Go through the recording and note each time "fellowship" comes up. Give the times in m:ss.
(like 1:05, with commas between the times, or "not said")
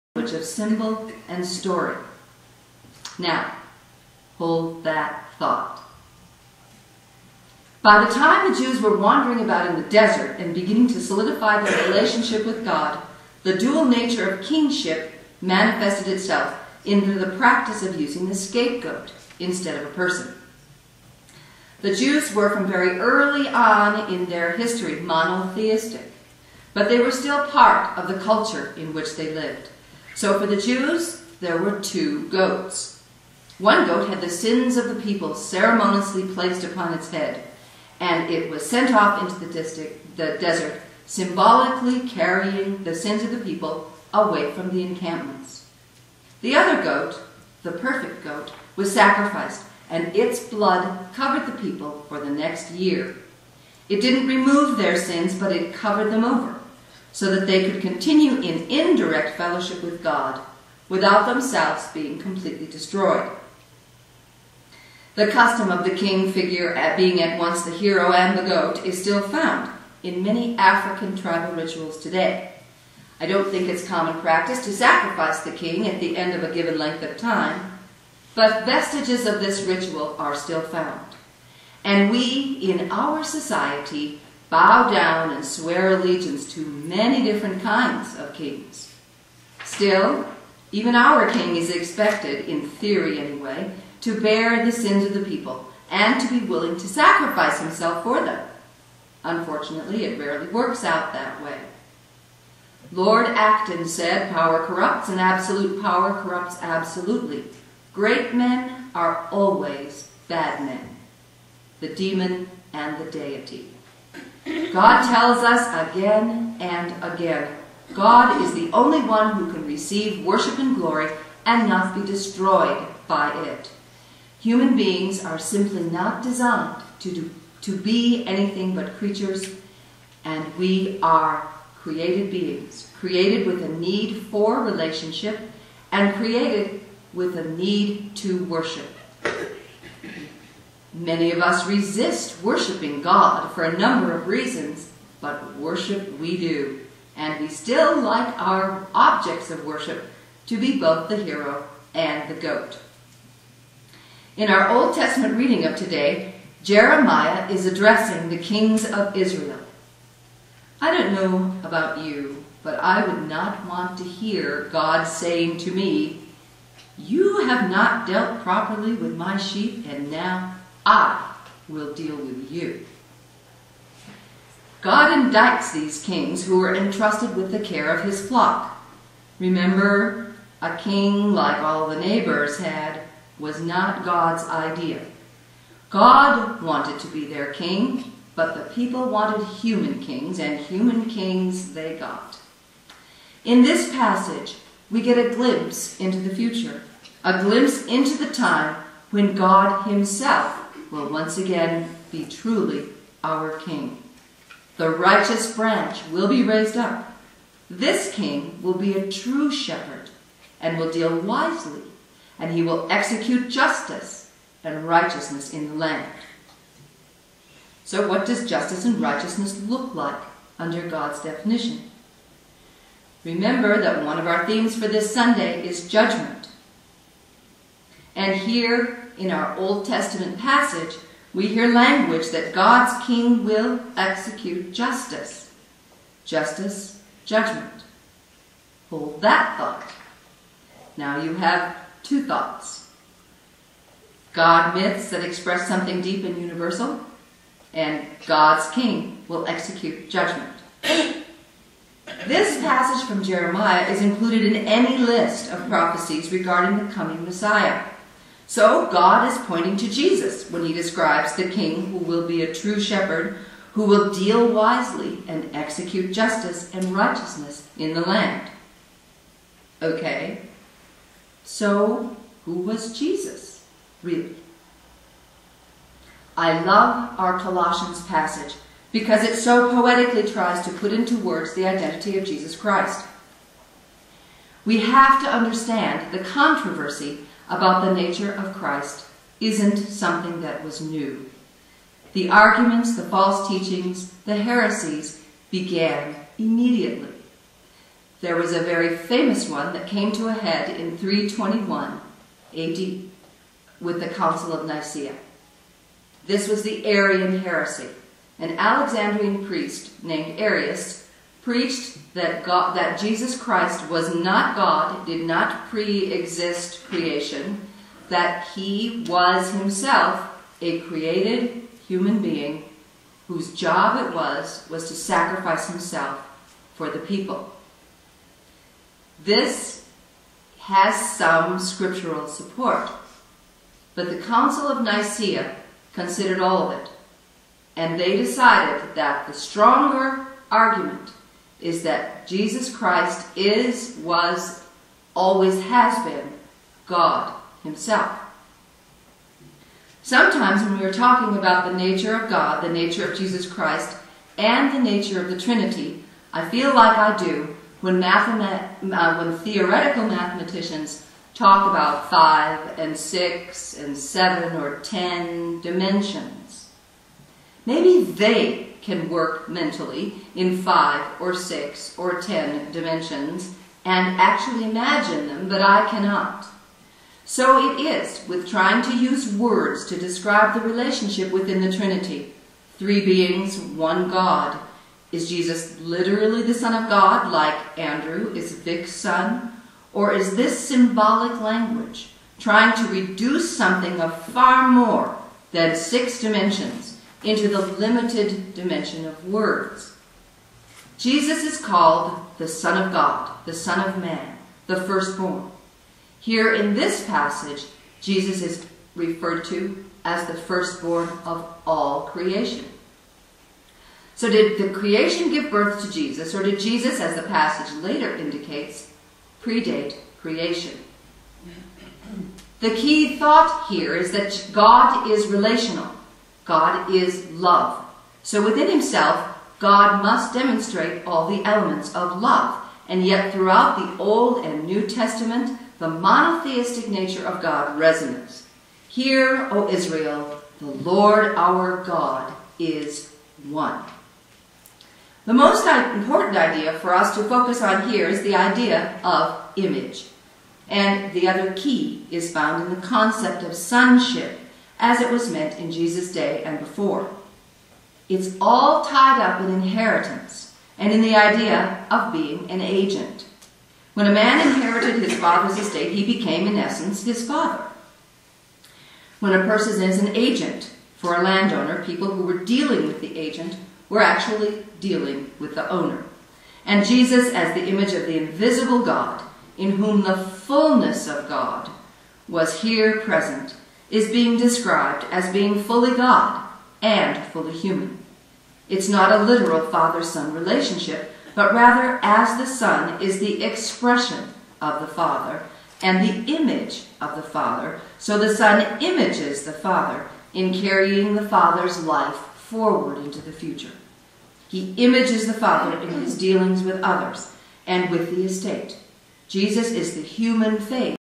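0:59.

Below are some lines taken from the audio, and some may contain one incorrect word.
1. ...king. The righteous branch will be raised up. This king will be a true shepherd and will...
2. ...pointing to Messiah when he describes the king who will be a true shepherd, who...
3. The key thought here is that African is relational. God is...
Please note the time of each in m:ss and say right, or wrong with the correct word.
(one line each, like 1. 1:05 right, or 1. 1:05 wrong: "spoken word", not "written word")
1. 3:23 right
2. 4:19 wrong: "Jesus", not "Messiah"
3. 7:02 wrong: "God", not "African".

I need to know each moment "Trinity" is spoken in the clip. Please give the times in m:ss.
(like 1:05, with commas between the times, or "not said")
5:55, 6:21.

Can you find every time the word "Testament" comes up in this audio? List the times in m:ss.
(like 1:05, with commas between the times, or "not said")
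2:34, 3:49, 7:14.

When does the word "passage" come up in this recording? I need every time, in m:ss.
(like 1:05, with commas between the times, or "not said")
3:13, 3:50, 4:12, 4:38, 6:47, 6:57.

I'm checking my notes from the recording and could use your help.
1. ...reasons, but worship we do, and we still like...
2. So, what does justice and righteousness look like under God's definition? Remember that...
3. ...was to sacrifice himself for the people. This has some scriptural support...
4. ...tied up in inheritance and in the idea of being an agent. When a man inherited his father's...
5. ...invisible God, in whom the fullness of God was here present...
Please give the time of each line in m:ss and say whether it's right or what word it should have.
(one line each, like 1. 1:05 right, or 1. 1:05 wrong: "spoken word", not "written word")
1. 2:24 right
2. 3:37 right
3. 5:24 right
4. 7:38 right
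5. 7:58 right.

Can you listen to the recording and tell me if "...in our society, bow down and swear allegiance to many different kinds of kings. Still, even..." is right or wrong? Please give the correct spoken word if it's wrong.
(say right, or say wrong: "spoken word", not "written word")
right.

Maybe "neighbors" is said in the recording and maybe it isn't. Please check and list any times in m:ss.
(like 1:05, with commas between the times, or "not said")
3:01.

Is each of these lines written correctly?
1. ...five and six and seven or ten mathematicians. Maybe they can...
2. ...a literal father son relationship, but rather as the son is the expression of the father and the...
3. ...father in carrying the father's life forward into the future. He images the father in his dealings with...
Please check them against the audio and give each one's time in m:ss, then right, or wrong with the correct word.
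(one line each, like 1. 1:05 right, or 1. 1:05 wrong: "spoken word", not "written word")
1. 6:02 wrong: "dimensions", not "mathematicians"
2. 8:09 right
3. 8:19 right.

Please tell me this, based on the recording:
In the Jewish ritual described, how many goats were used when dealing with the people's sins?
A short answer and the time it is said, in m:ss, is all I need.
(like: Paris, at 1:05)
2, at 0:31.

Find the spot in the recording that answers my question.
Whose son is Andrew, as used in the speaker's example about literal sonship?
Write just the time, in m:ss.
6:28.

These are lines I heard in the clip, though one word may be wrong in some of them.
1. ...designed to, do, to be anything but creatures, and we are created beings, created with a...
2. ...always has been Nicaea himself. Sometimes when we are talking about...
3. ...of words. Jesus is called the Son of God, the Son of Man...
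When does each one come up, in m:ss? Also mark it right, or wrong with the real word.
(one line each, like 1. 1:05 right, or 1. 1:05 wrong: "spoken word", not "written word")
1. 2:06 right
2. 5:45 wrong: "God", not "Nicaea"
3. 6:39 right.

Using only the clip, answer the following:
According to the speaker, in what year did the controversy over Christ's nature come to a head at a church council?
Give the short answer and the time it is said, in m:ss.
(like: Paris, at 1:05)
321 AD, at 5:00.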